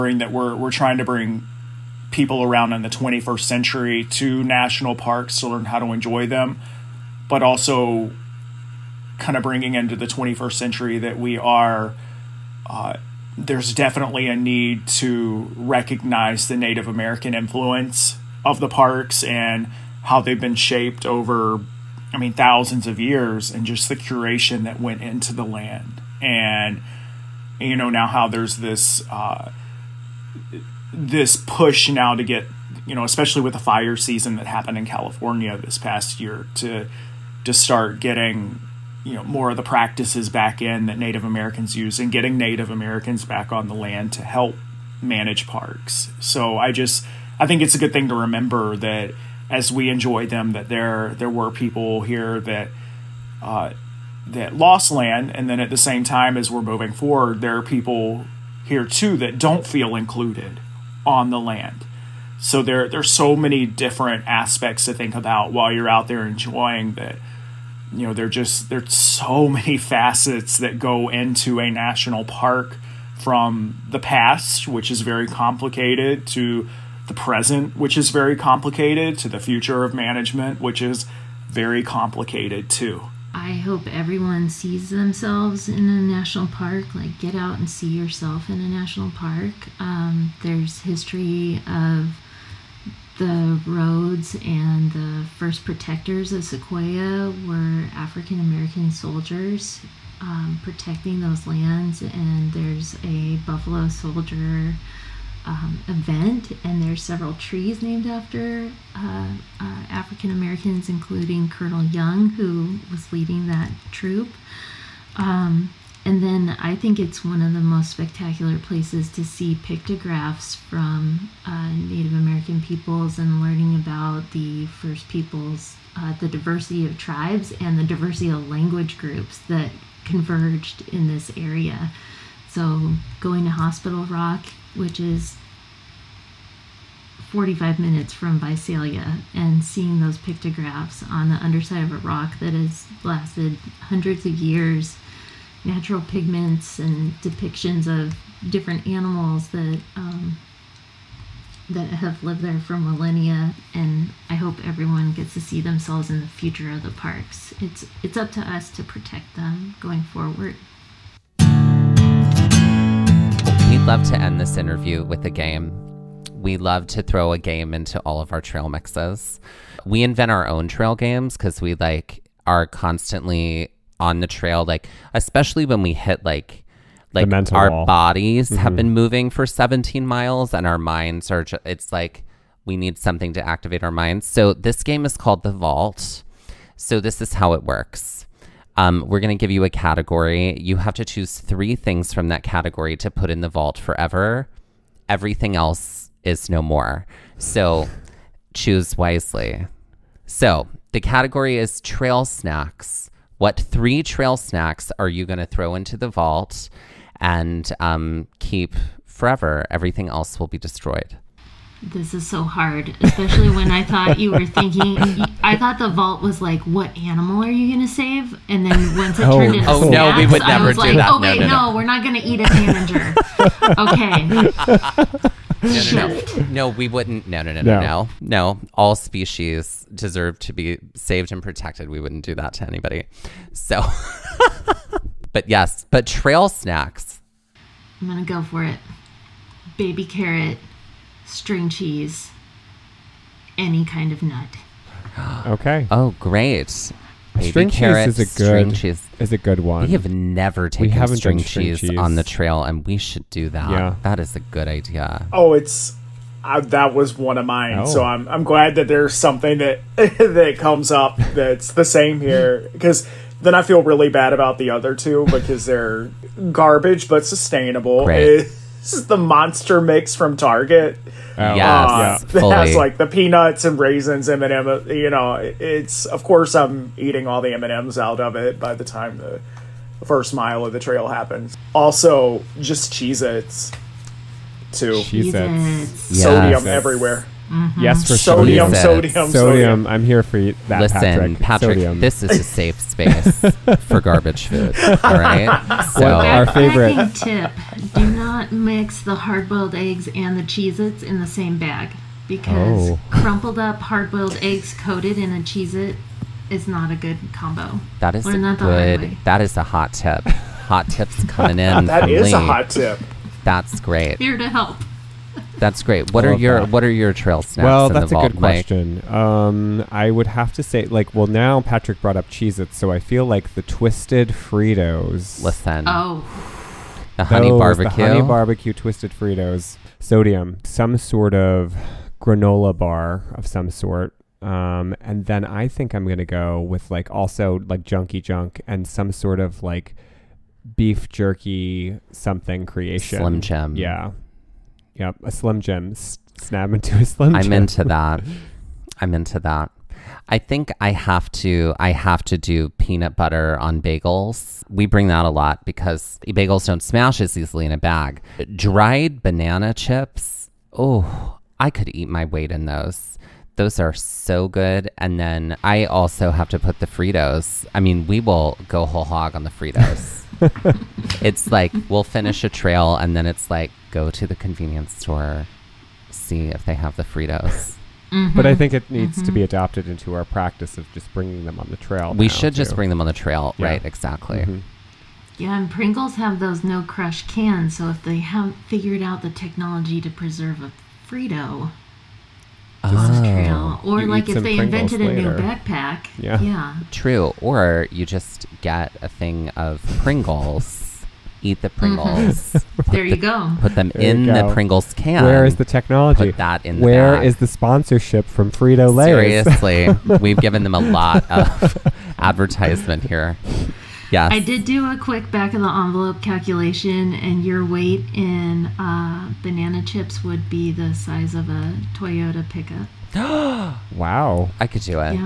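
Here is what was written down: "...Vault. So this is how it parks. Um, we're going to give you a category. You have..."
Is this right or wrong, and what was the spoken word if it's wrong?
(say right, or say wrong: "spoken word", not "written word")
wrong: "works", not "parks".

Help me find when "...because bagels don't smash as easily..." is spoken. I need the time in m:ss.
5:55.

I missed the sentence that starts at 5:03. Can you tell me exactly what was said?
crumpled up hard-boiled eggs coated in a Cheez-It is not a good combo.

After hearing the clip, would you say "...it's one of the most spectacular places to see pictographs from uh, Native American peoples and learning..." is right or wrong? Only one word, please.
right.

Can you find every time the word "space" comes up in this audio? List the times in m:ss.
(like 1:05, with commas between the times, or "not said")
4:52.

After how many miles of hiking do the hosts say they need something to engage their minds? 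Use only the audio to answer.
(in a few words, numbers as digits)
17 miles.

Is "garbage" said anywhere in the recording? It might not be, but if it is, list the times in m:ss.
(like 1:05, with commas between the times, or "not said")
4:26, 4:54.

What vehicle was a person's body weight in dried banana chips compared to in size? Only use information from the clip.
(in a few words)
Toyota pickup.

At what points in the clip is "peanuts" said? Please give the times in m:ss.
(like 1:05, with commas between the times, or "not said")
4:33, 5:52.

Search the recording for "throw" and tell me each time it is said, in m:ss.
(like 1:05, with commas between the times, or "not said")
2:47, 3:25.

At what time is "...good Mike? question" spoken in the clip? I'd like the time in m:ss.
5:18.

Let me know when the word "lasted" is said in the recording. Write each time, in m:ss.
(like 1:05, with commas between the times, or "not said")
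2:23.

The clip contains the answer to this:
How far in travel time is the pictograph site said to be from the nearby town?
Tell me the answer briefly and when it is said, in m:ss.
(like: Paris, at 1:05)
45 minutes, at 2:17.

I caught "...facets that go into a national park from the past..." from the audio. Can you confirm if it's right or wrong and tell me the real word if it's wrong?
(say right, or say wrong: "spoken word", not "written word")
right.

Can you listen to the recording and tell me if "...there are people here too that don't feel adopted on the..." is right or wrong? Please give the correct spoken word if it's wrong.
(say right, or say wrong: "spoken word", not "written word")
wrong: "included", not "adopted".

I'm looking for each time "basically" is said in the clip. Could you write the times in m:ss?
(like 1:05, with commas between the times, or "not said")
not said.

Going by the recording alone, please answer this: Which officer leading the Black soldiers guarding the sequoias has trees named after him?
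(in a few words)
Colonel Young.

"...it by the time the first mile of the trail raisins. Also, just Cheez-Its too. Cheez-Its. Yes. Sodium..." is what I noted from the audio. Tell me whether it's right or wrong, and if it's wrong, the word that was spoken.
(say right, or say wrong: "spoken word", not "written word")
wrong: "happens", not "raisins".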